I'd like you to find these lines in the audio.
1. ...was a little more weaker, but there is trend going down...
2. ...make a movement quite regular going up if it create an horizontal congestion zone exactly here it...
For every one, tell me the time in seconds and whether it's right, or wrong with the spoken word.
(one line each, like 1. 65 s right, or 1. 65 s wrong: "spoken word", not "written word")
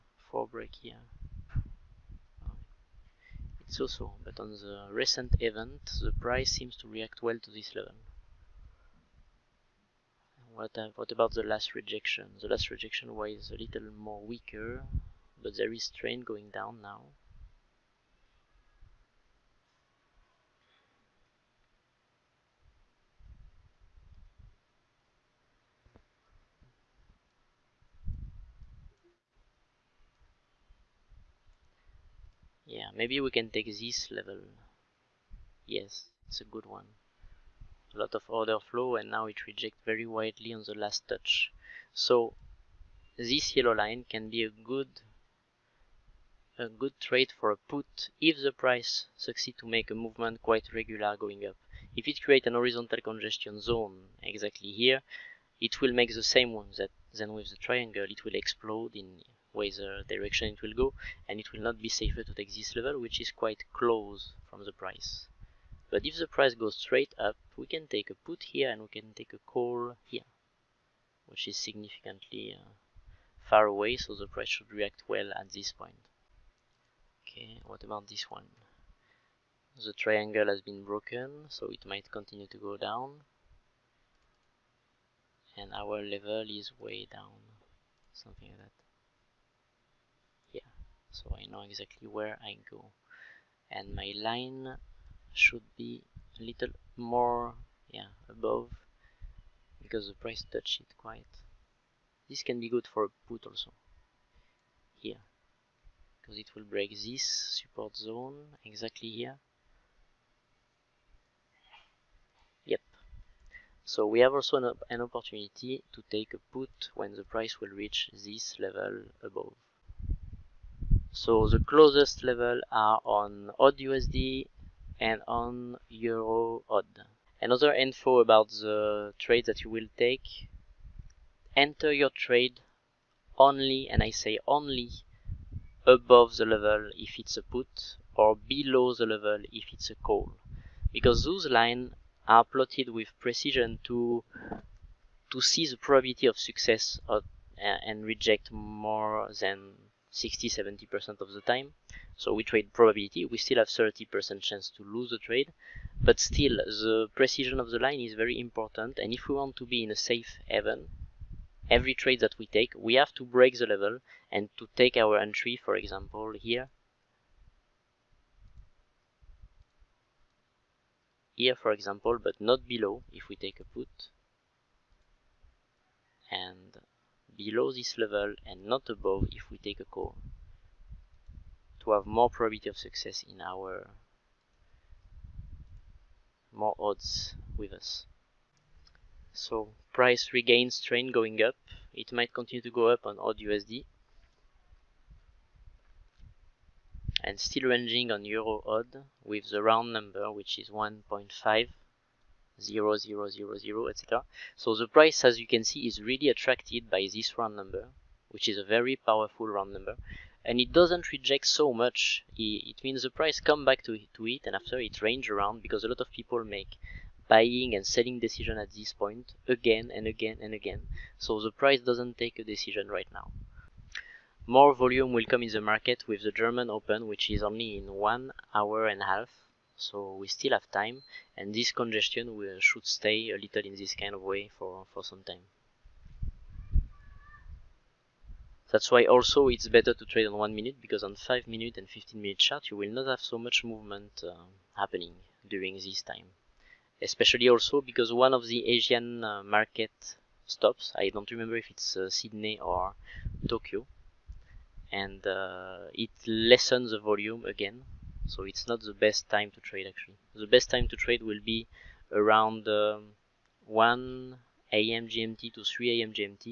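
1. 13 s right
2. 49 s right.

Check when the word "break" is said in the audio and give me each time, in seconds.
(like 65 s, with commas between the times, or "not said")
0 s, 106 s, 163 s.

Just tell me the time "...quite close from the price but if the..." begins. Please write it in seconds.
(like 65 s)
63 s.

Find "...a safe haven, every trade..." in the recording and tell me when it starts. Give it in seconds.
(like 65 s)
159 s.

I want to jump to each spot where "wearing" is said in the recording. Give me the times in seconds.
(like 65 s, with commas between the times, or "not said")
not said.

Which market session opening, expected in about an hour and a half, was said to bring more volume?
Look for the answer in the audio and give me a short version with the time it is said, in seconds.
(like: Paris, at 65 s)
German Open, at 226 s.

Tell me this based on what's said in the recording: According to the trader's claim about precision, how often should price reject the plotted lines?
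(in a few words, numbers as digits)
60-70%.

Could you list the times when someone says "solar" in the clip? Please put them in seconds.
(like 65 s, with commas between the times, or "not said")
not said.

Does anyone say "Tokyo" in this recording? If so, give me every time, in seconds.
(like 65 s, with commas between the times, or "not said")
253 s.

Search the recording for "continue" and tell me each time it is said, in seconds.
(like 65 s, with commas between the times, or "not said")
82 s, 192 s.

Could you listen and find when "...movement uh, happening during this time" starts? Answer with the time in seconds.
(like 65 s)
243 s.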